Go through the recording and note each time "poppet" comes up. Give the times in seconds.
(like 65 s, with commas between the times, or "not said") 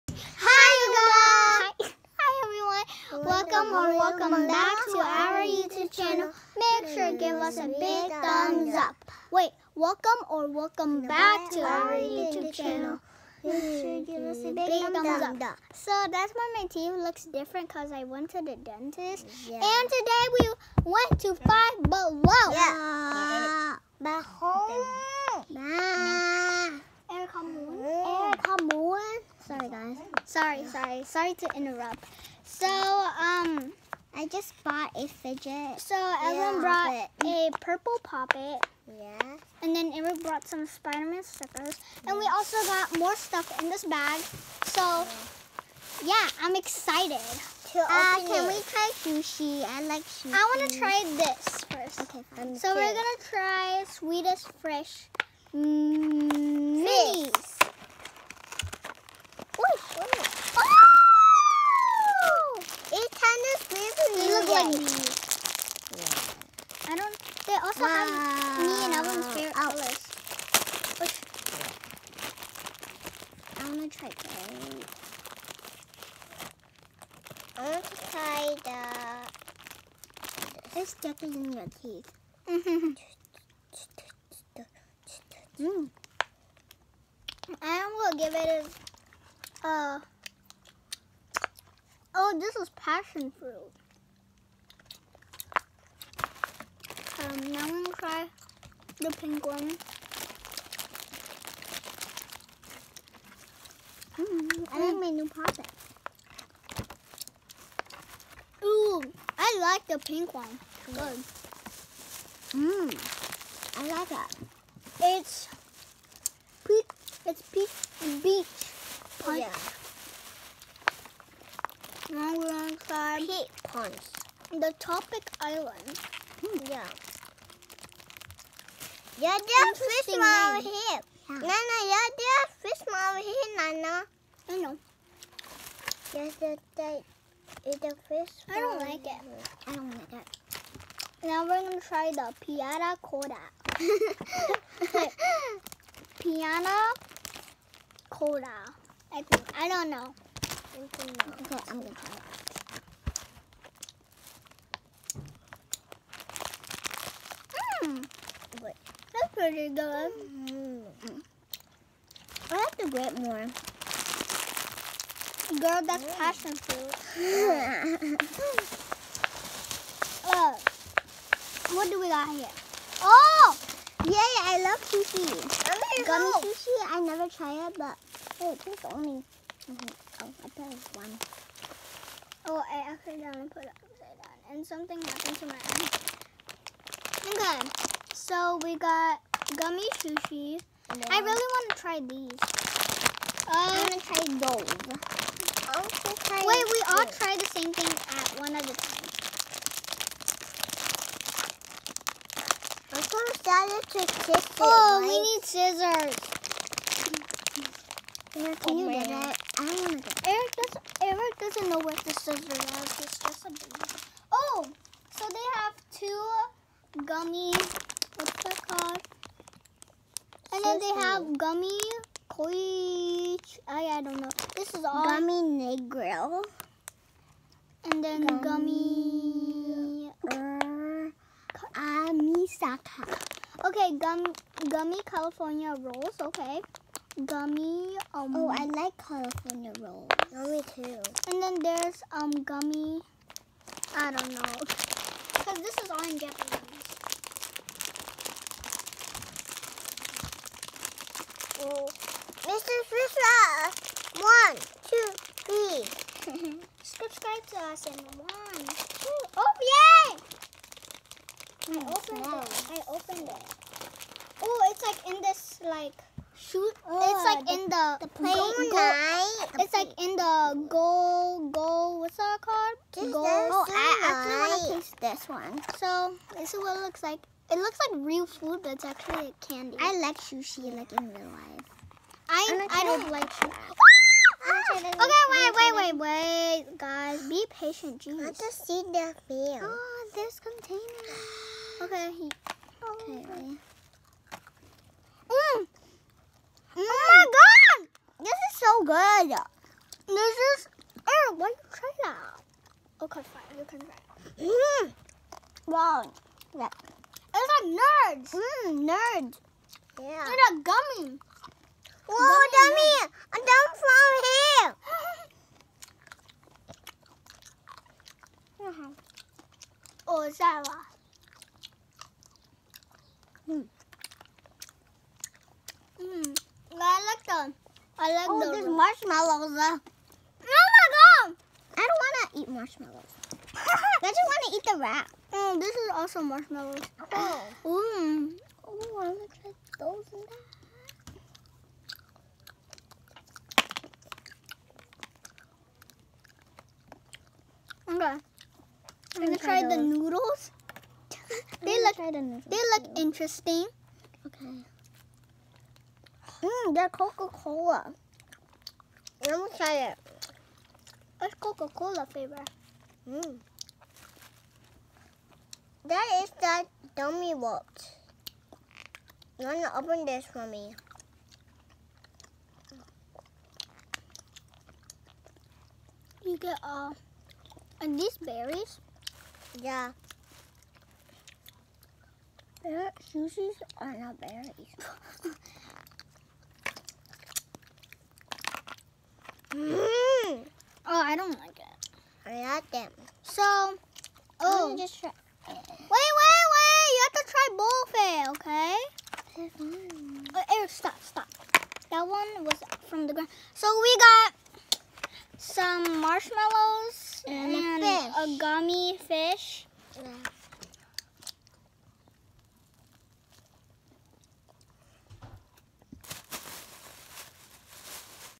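38 s, 105 s.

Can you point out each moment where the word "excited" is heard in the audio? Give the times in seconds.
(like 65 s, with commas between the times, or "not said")
46 s.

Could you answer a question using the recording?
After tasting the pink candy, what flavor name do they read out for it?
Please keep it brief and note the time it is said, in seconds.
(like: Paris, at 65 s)
peach beach punch, at 117 s.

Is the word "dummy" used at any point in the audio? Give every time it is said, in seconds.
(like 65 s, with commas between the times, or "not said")
312 s, 366 s.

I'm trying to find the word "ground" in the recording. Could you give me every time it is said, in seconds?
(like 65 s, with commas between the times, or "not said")
403 s.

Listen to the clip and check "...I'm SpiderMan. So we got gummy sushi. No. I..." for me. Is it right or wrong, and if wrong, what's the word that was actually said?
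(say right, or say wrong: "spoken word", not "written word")
wrong: "Okay", not "SpiderMan".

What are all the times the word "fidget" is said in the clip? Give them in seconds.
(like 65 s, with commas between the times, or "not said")
35 s.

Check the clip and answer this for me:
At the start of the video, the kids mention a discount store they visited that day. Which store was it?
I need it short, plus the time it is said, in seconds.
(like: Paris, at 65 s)
Five Below, at 21 s.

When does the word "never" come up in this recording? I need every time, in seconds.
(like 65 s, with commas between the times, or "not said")
177 s.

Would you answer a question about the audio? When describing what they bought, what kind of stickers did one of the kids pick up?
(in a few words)
Spider-Man.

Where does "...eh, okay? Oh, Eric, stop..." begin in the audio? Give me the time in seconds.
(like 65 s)
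398 s.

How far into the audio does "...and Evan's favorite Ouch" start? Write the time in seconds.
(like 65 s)
68 s.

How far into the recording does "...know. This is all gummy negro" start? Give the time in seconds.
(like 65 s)
224 s.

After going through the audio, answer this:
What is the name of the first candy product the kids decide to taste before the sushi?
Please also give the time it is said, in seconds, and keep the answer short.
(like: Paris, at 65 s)
Sweetest Fresh Minis, at 53 s.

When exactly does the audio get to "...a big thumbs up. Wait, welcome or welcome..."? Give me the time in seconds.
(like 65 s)
7 s.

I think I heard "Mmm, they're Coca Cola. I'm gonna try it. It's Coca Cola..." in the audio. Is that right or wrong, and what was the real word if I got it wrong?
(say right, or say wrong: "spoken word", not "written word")
right.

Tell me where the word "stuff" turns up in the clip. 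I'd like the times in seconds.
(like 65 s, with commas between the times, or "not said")
43 s, 80 s.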